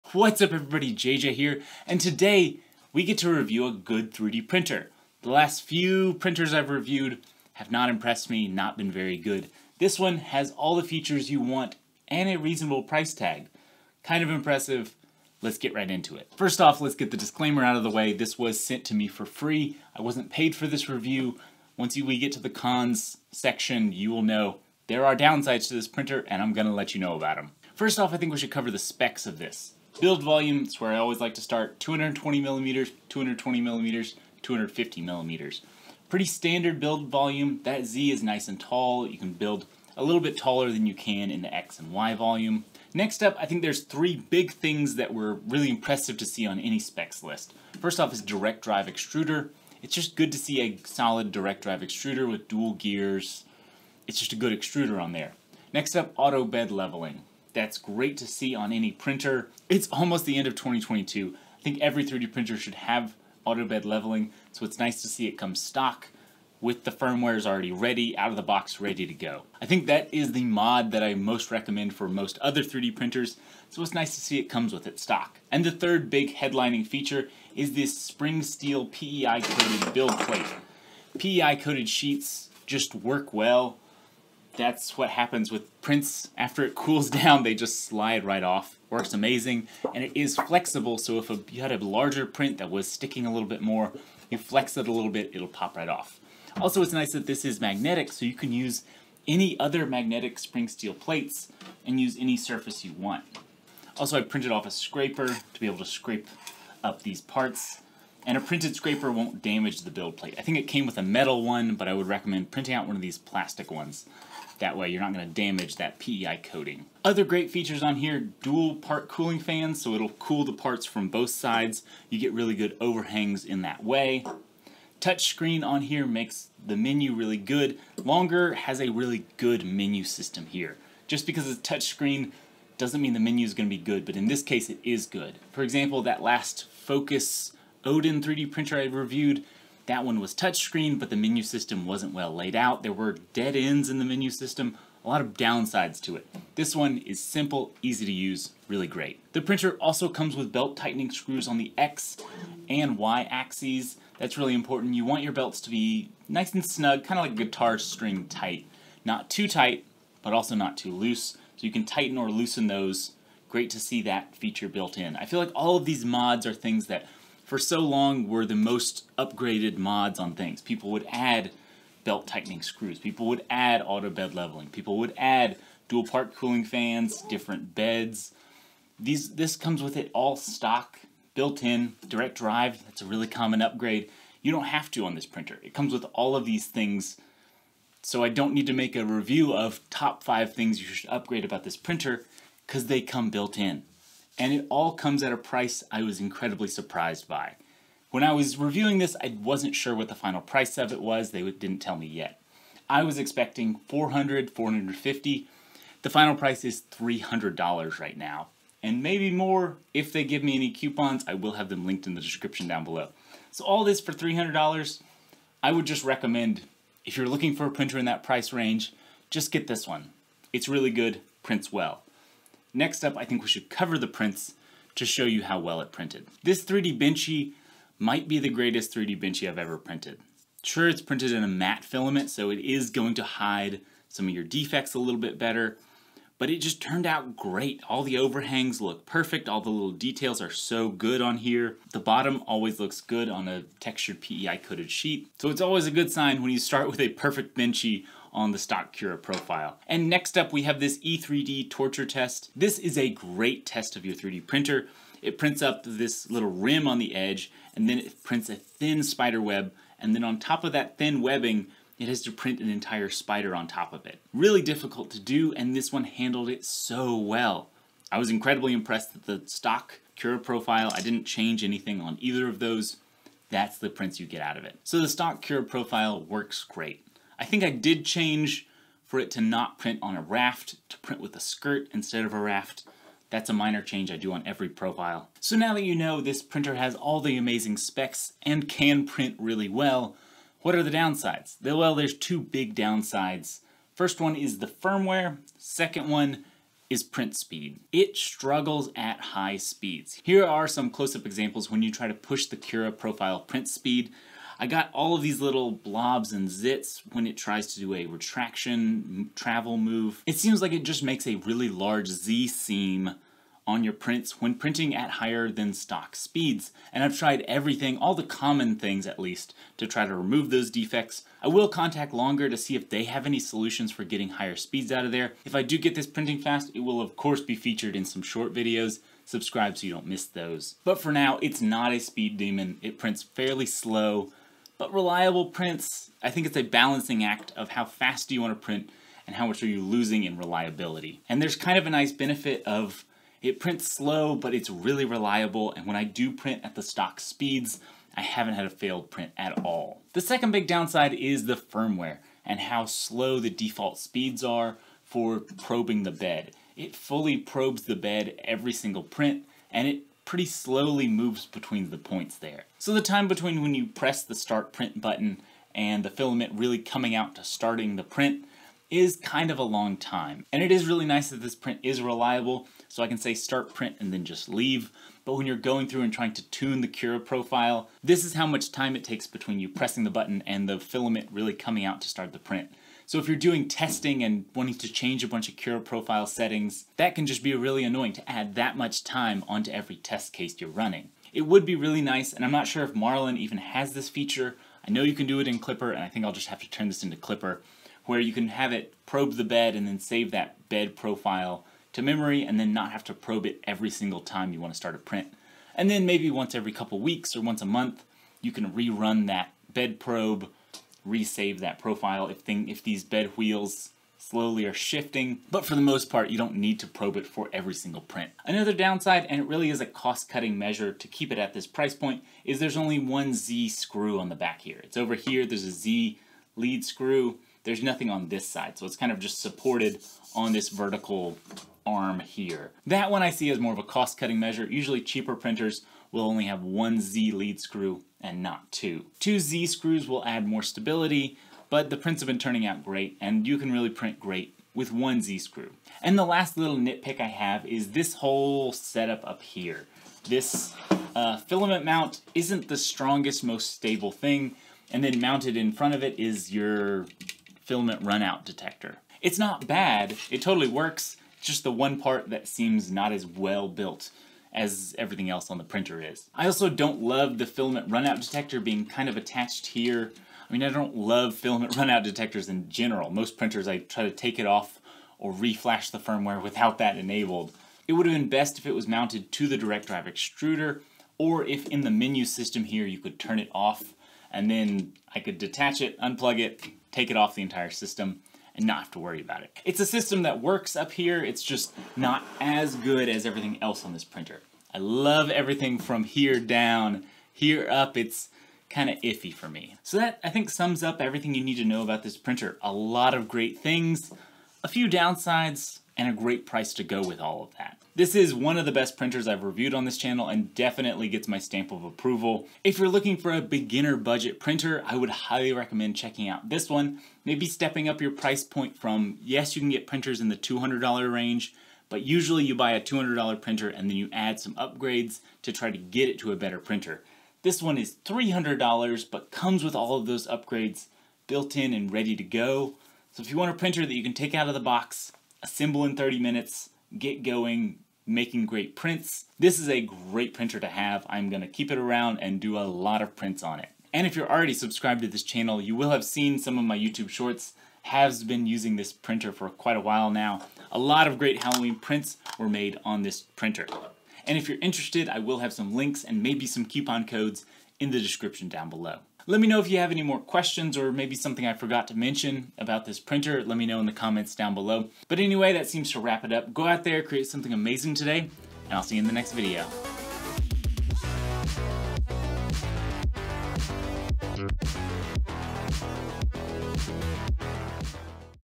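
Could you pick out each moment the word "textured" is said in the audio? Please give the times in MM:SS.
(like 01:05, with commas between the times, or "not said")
04:03.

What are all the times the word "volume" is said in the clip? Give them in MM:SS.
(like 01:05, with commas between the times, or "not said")
00:30, 00:37, 00:42.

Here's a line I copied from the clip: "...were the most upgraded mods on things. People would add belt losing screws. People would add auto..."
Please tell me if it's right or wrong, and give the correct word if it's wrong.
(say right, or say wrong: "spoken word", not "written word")
wrong: "tightening", not "losing".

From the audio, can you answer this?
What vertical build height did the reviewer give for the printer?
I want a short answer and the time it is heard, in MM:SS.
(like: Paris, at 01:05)
250 millimeters, at 00:34.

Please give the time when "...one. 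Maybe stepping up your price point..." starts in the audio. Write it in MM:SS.
08:36.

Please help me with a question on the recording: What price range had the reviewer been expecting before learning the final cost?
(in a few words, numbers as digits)
400 to 450.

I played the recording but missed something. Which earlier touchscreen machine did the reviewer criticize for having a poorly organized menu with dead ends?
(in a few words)
Fokoos Odin.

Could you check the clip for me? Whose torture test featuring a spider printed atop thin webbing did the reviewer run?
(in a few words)
E3D.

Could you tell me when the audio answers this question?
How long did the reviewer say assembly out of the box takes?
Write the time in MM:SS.
08:55.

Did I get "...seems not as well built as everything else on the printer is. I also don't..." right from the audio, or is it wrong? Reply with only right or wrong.
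right.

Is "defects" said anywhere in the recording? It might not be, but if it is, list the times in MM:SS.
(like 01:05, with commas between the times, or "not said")
03:54, 05:20.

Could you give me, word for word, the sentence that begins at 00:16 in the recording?
First off, let's get the disclaimer out of the way.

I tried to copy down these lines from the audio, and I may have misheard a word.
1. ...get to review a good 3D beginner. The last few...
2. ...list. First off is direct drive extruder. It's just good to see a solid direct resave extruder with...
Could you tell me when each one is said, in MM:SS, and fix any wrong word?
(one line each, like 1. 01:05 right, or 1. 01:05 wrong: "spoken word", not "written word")
1. 00:03 wrong: "printer", not "beginner"
2. 00:47 wrong: "drive", not "resave".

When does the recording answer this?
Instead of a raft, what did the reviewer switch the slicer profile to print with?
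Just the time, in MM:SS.
04:41.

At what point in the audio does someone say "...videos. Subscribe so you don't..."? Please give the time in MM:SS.
05:28.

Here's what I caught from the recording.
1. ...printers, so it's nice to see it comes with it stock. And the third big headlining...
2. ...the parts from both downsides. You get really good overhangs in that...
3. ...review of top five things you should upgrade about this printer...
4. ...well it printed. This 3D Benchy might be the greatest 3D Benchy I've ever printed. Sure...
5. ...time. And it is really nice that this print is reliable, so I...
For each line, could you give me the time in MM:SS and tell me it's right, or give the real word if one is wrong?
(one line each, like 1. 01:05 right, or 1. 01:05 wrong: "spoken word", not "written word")
1. 01:12 right
2. 02:00 wrong: "sides", not "downsides"
3. 03:09 right
4. 03:45 right
5. 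06:09 right.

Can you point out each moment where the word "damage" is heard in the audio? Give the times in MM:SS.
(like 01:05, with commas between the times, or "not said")
01:49, 01:55.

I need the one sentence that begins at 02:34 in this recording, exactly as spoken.
You want your belts to be nice and snug, kind of like a guitar string tight.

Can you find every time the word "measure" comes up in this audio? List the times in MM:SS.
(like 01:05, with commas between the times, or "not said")
07:00, 07:14.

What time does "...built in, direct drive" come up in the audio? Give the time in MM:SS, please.
03:01.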